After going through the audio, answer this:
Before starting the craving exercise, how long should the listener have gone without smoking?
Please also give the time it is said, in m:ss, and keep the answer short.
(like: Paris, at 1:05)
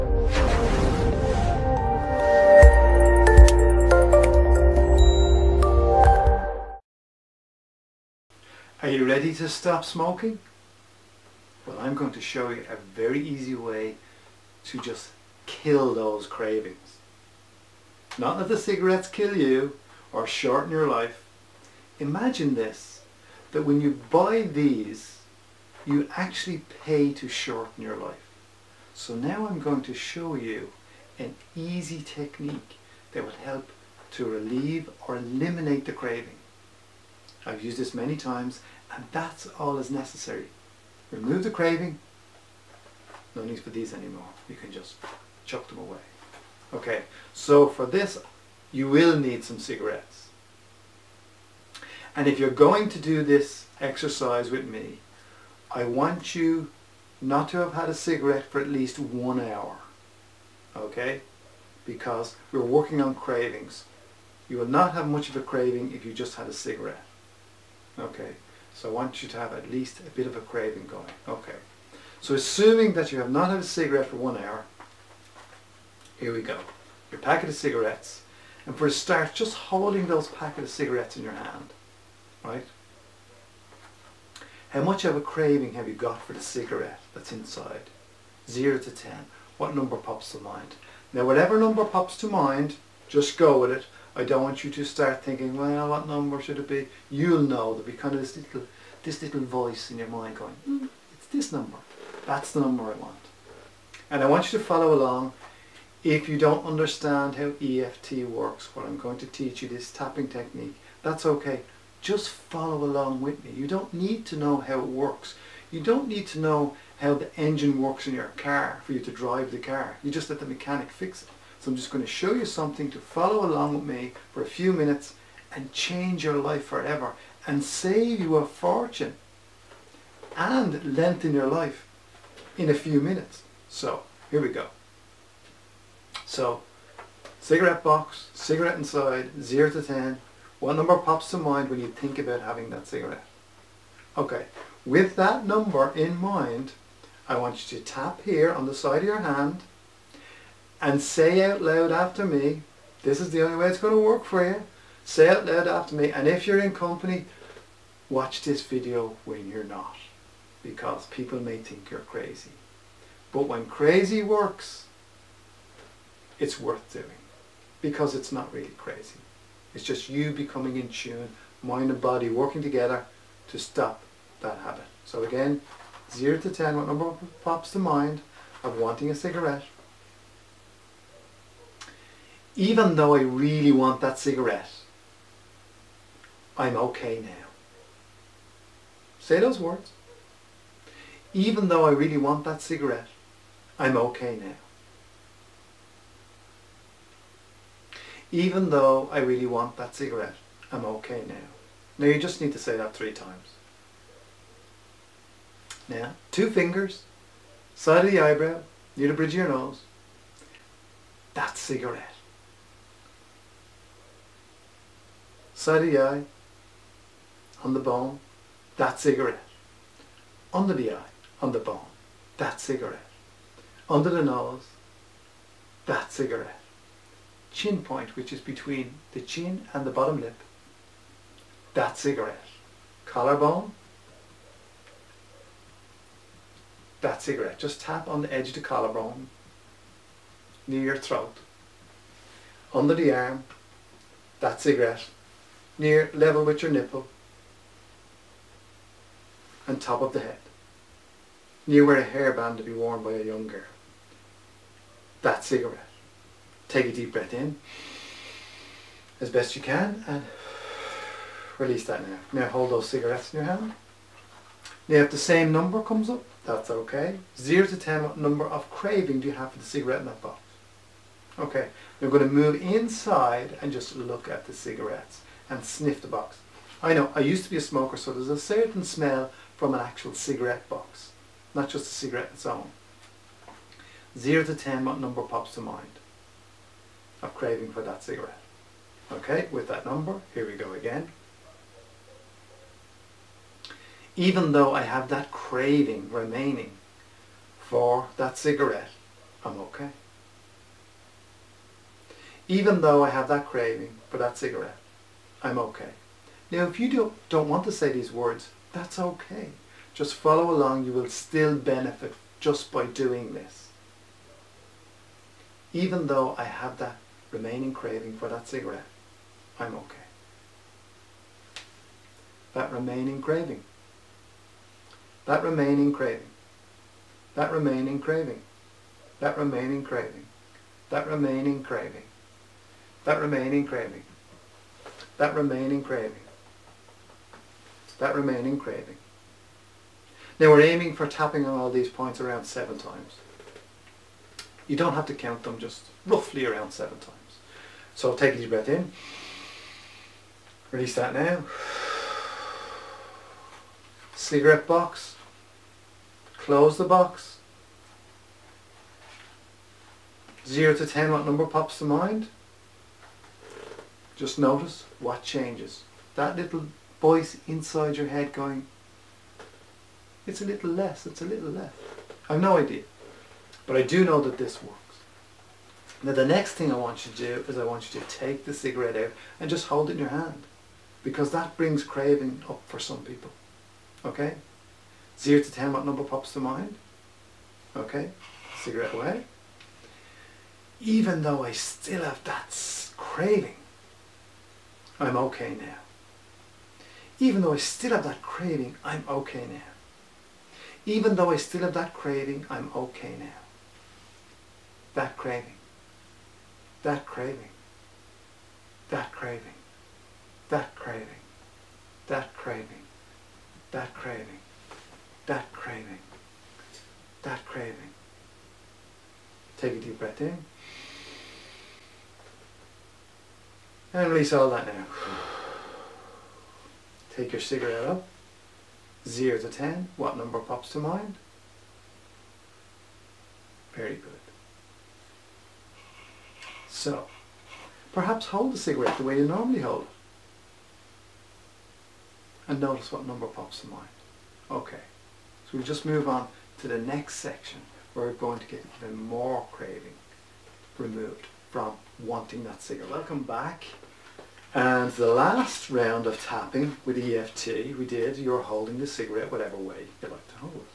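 1 hour, at 0:58.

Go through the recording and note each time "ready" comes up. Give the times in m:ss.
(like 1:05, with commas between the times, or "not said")
0:09.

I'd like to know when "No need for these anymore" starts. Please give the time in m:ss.
0:43.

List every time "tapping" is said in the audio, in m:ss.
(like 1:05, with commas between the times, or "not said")
1:49, 5:41, 7:36.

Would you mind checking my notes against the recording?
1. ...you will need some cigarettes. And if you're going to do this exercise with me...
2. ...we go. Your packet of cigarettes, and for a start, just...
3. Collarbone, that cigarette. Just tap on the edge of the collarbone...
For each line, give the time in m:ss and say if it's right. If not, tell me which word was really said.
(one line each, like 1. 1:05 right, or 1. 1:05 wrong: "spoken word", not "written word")
1. 0:48 right
2. 1:16 right
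3. 3:53 right.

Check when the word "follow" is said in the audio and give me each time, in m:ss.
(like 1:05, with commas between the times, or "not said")
1:44, 1:52, 2:02, 5:10.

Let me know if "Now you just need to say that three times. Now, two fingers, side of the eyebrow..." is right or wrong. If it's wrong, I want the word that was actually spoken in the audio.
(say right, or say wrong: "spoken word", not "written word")
right.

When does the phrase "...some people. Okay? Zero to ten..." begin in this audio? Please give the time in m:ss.
6:22.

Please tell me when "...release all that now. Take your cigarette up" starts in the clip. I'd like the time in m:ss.
7:04.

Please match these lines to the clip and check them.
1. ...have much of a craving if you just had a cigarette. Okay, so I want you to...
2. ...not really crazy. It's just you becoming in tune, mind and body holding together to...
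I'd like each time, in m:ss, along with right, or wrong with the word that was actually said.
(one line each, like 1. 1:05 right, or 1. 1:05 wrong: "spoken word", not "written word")
1. 1:04 right
2. 2:48 wrong: "working", not "holding".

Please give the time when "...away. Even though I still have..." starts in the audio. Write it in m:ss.
6:28.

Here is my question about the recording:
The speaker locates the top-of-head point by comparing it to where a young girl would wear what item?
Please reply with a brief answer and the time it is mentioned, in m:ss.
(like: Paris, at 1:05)
A hairband, at 4:12.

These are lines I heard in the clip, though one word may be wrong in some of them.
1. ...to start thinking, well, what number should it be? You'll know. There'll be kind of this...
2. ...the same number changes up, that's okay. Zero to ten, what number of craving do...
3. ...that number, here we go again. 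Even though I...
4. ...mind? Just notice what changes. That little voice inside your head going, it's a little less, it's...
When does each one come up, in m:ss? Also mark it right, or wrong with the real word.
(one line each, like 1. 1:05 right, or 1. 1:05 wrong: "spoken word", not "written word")
1. 1:34 right
2. 4:25 wrong: "comes", not "changes"
3. 4:49 right
4. 6:01 right.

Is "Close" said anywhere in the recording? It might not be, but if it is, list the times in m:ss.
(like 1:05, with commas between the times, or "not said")
5:56.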